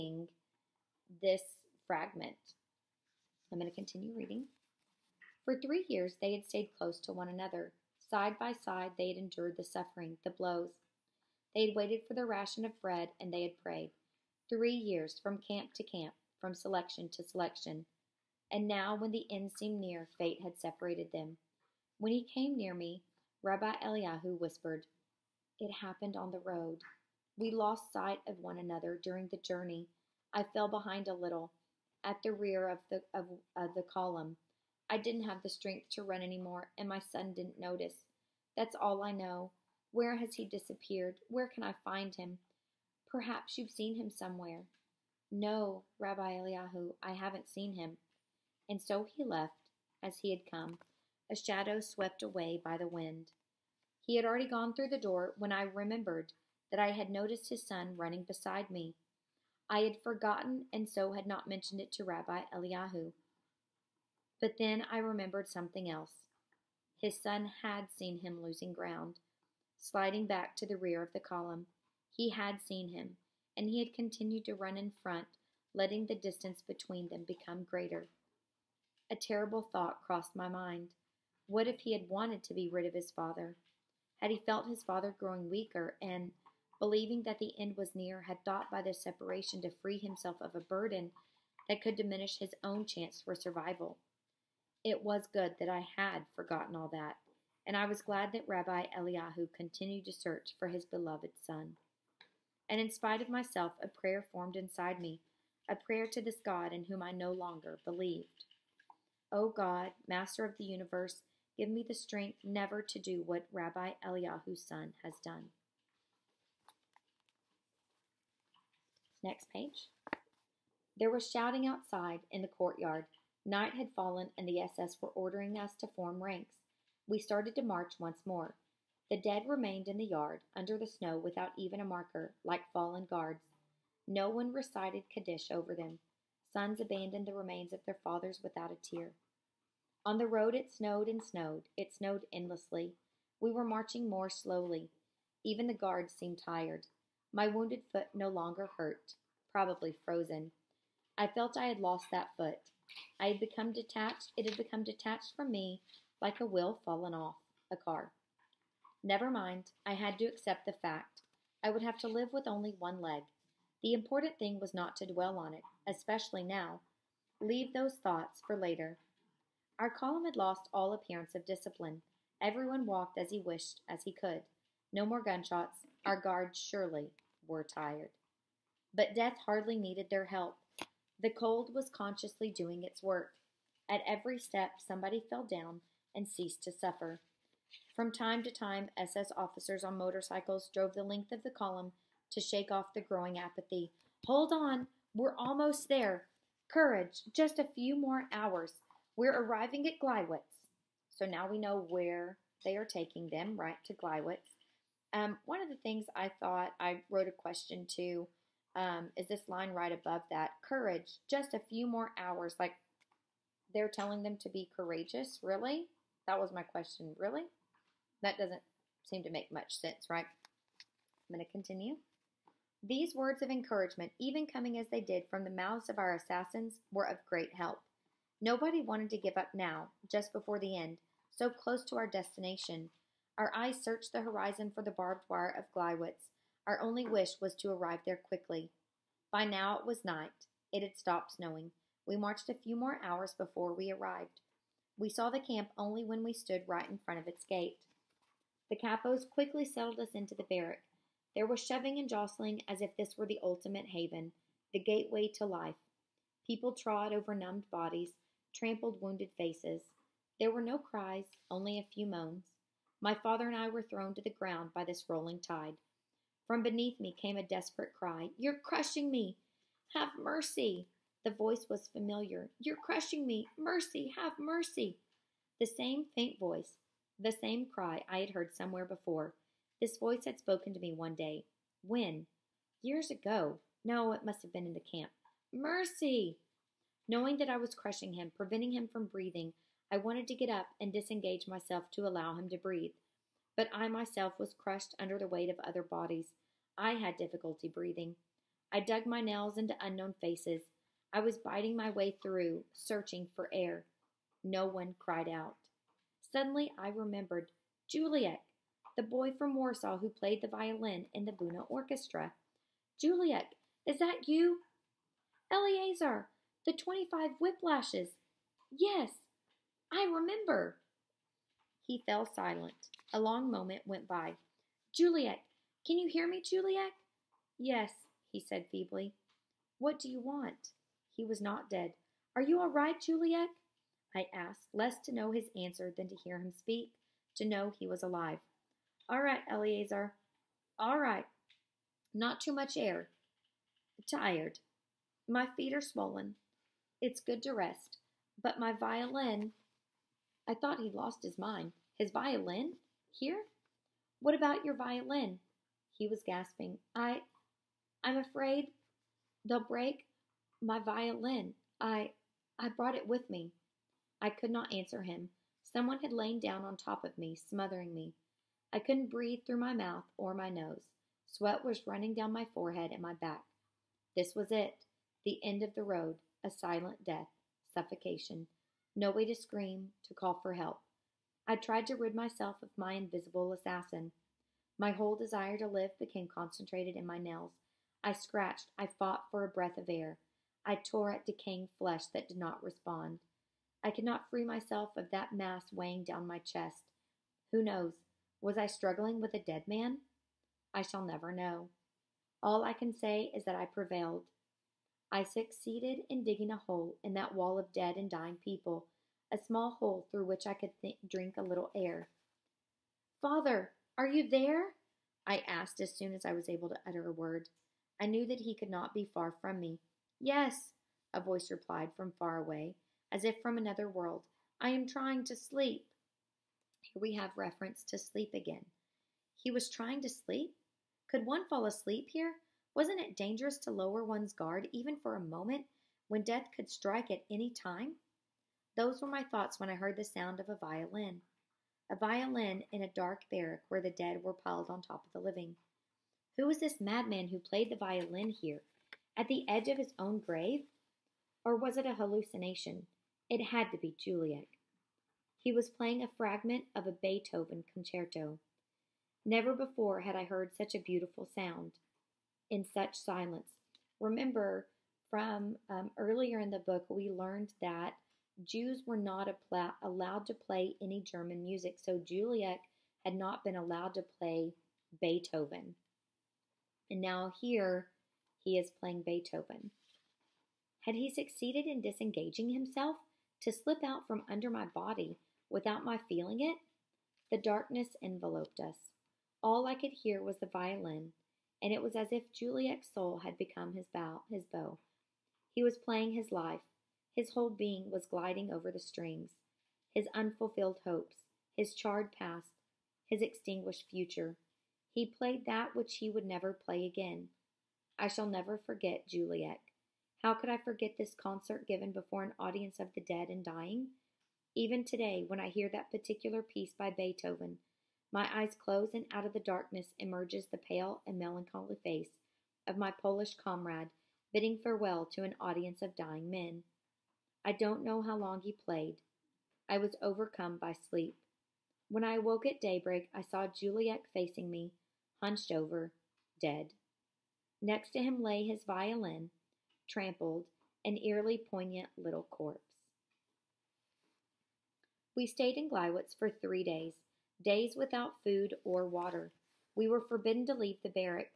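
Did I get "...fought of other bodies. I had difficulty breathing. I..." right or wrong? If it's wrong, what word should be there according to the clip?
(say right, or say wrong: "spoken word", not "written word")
wrong: "weight", not "fought".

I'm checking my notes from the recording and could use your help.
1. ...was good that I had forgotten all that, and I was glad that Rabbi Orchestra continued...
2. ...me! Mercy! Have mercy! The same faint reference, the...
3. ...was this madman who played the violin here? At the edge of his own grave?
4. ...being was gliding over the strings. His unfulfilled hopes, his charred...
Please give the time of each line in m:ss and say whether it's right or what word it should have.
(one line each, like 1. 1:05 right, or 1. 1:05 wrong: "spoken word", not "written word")
1. 1:35 wrong: "Eliyahu", not "Orchestra"
2. 4:33 wrong: "voice", not "reference"
3. 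7:26 right
4. 8:17 right.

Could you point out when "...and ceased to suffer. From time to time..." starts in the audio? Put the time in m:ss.
3:06.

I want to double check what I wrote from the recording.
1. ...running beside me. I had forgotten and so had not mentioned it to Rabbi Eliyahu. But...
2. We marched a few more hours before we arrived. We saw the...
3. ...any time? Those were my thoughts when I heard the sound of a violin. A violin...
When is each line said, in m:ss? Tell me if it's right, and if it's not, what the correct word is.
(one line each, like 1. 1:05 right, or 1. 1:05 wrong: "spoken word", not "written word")
1. 0:57 right
2. 4:02 right
3. 7:17 right.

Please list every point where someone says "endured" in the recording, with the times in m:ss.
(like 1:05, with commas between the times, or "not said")
0:09.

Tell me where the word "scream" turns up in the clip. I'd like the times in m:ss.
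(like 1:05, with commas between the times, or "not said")
6:19.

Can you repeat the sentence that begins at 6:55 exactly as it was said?
I asked as soon as I was able to utter a word.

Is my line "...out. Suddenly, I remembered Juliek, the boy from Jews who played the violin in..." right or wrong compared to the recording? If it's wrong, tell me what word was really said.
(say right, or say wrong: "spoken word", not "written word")
wrong: "Warsaw", not "Jews".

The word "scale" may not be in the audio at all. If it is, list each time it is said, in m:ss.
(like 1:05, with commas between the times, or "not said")
not said.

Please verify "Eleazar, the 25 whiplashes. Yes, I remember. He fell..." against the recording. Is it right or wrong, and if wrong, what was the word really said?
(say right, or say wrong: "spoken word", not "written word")
right.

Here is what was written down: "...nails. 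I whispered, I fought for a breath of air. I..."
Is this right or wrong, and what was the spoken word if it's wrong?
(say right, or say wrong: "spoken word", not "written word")
wrong: "scratched", not "whispered".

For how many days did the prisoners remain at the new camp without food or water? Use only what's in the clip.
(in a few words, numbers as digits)
3.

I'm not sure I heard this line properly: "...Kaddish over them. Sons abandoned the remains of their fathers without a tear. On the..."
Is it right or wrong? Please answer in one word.
right.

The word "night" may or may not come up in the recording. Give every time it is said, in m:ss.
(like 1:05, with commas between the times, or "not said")
2:03, 4:00.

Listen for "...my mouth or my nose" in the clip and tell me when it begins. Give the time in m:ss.
6:09.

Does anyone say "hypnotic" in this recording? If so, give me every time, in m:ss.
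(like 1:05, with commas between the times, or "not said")
not said.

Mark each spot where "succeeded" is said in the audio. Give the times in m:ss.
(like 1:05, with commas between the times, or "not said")
6:45, 8:01.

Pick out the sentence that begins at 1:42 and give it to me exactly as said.
And in spite of myself, a prayer formed inside me, a prayer to this God in whom I no longer believed.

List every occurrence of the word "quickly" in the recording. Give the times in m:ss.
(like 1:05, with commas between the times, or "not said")
3:58, 4:09.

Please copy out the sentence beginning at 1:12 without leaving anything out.
He had seen him, and he had continued to run in front, letting the distance between them become greater.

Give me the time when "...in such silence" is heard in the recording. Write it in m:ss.
7:42.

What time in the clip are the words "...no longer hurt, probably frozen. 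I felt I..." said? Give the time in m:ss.
2:28.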